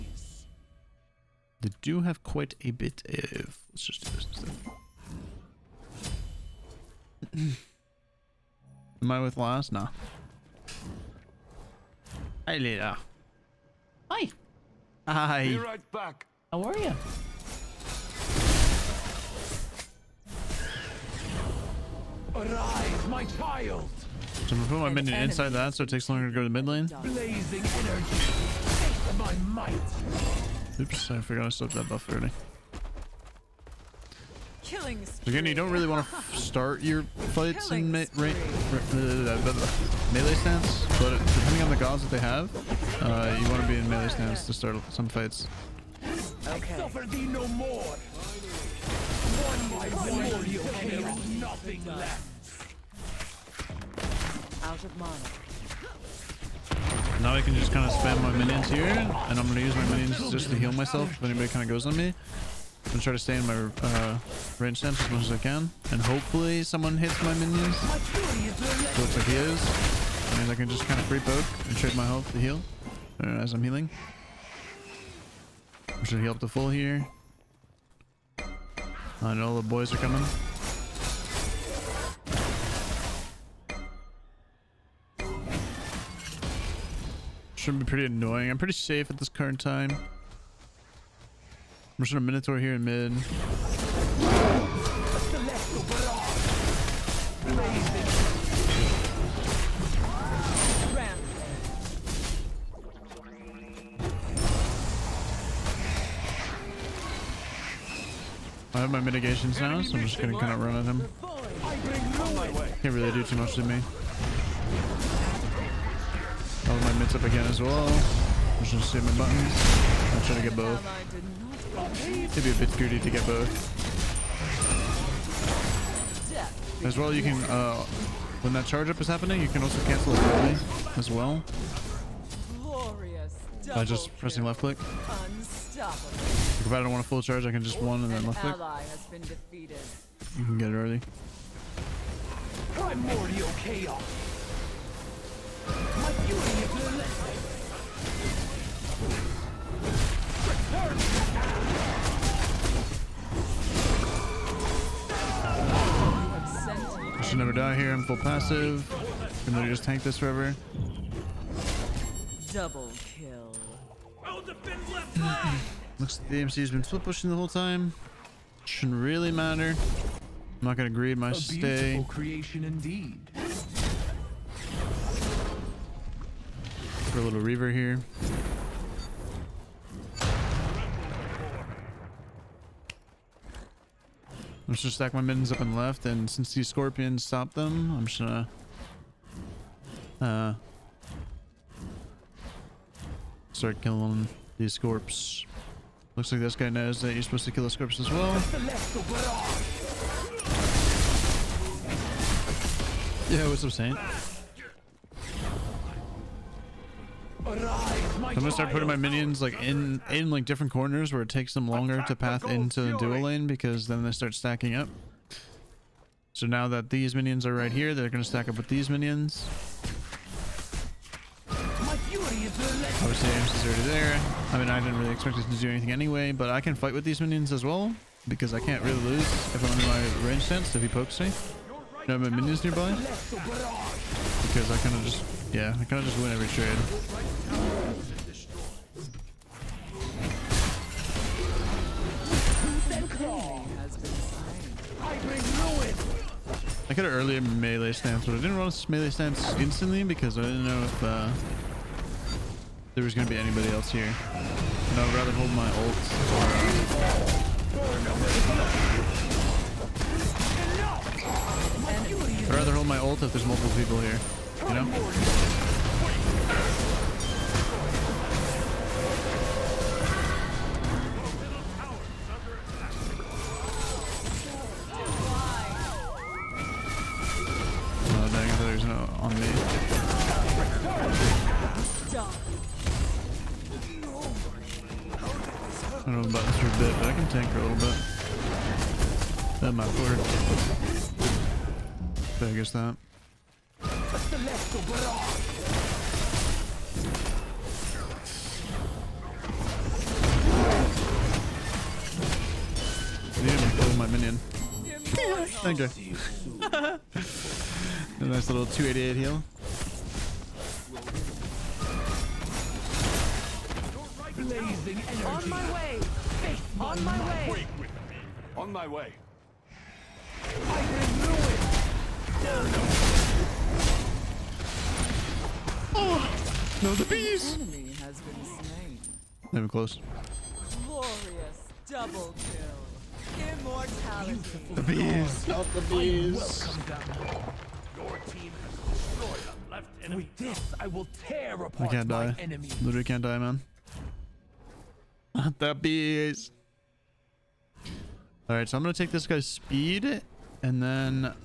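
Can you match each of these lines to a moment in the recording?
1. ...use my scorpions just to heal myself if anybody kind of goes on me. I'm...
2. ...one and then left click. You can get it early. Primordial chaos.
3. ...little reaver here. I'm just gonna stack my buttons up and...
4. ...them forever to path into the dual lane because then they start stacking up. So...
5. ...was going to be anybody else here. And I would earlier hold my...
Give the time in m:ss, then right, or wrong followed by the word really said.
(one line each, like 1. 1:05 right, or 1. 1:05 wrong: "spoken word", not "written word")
1. 0:59 wrong: "minions", not "scorpions"
2. 2:17 right
3. 2:57 wrong: "mittens", not "buttons"
4. 3:31 wrong: "longer", not "forever"
5. 4:13 wrong: "rather", not "earlier".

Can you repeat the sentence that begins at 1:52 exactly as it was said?
Can't really do too much to me.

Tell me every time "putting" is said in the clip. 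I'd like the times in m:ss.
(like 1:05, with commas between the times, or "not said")
3:28.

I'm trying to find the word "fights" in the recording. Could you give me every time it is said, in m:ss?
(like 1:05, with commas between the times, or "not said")
0:37, 0:45, 3:46.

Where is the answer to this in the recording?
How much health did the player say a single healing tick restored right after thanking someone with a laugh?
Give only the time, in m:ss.
5:08.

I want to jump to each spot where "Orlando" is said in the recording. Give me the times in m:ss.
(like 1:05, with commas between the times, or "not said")
not said.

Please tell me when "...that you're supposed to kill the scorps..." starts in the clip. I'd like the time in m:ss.
3:17.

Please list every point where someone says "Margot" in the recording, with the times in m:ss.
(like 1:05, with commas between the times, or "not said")
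not said.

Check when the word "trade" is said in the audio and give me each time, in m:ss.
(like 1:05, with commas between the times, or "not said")
1:11, 3:56.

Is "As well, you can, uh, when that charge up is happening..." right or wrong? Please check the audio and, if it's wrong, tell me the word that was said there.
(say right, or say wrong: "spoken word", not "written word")
right.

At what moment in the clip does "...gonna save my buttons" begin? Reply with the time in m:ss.
1:58.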